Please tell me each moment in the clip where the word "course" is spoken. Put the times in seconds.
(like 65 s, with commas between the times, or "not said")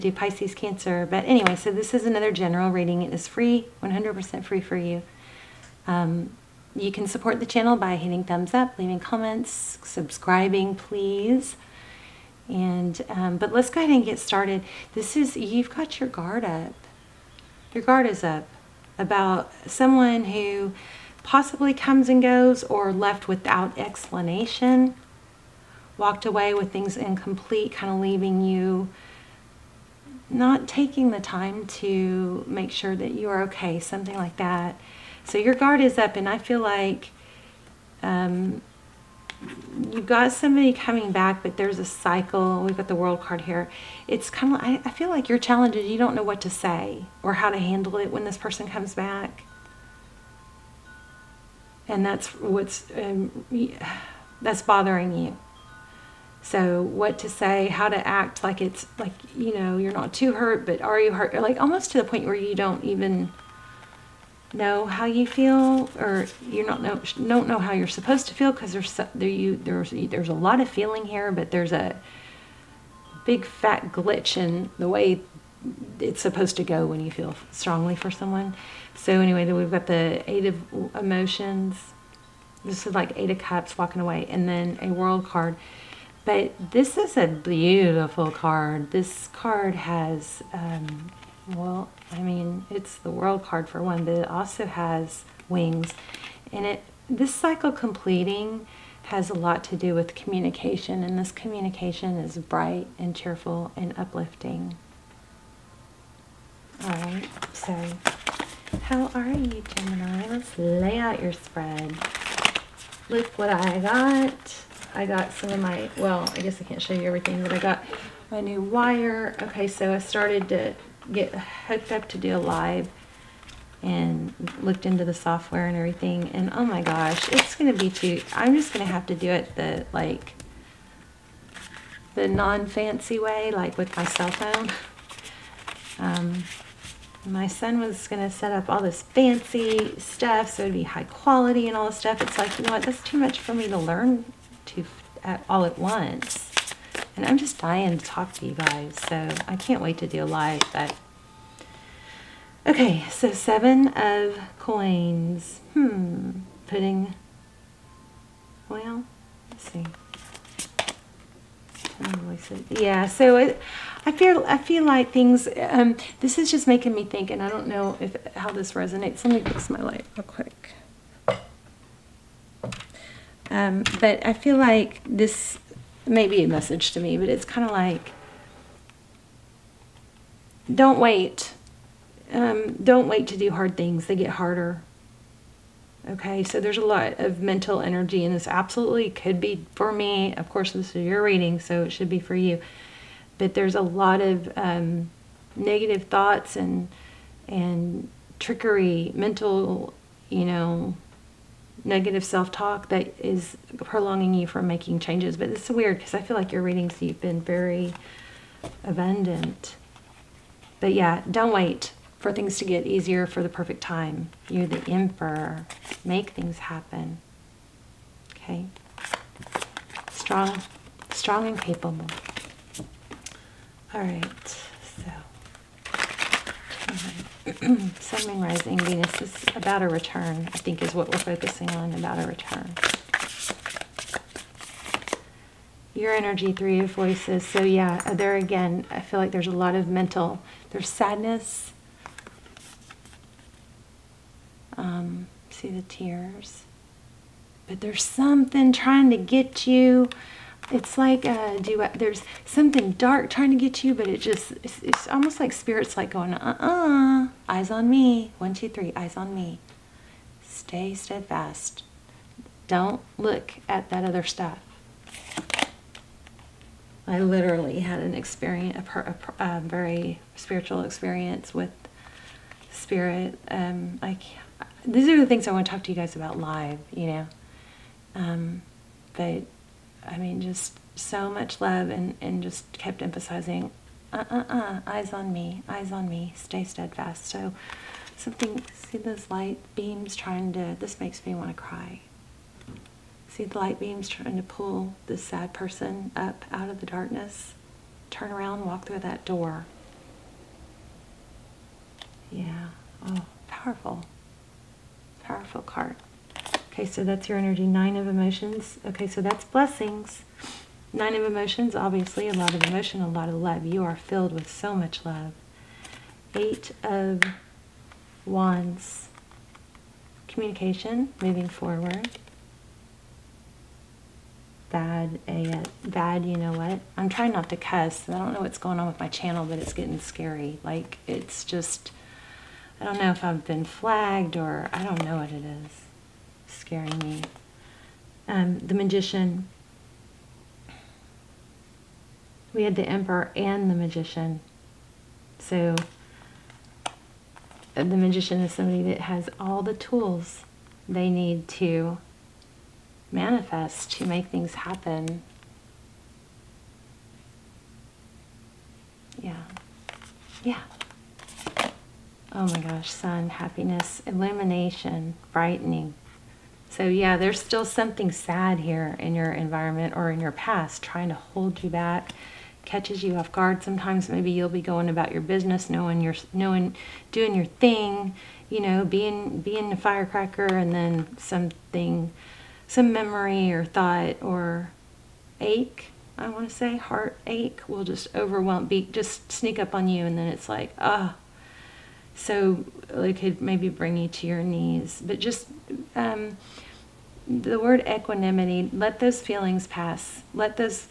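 190 s.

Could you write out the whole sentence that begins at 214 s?
You're the emperor make things happen.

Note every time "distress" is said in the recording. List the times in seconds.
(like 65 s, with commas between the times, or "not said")
not said.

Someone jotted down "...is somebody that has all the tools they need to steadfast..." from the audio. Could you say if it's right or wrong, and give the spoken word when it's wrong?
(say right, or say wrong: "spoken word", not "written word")
wrong: "manifest", not "steadfast".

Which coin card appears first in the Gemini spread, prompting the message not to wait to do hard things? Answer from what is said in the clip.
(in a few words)
Seven of coins.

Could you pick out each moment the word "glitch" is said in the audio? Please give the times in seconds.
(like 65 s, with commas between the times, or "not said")
73 s.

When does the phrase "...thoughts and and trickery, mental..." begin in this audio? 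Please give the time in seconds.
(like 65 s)
196 s.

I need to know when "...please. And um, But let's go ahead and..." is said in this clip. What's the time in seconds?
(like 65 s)
10 s.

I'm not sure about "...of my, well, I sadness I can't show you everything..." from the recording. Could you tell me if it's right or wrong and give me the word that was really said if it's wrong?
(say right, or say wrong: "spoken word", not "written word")
wrong: "guess", not "sadness".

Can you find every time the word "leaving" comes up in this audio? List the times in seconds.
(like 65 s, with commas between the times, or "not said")
8 s, 27 s.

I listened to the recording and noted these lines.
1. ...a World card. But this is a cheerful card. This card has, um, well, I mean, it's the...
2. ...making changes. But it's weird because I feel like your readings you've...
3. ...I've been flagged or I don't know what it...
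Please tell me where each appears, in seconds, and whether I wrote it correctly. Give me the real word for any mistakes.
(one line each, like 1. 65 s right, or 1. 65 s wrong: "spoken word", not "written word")
1. 84 s wrong: "beautiful", not "cheerful"
2. 204 s right
3. 333 s right.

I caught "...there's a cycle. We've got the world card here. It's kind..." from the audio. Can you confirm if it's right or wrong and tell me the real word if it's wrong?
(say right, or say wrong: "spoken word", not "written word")
right.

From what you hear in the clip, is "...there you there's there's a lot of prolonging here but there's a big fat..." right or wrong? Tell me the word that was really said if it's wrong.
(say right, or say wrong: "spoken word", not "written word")
wrong: "feeling", not "prolonging".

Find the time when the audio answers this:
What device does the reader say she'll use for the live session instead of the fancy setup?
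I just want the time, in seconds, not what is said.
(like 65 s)
133 s.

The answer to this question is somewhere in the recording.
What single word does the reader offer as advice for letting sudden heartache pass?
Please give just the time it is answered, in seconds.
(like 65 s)
397 s.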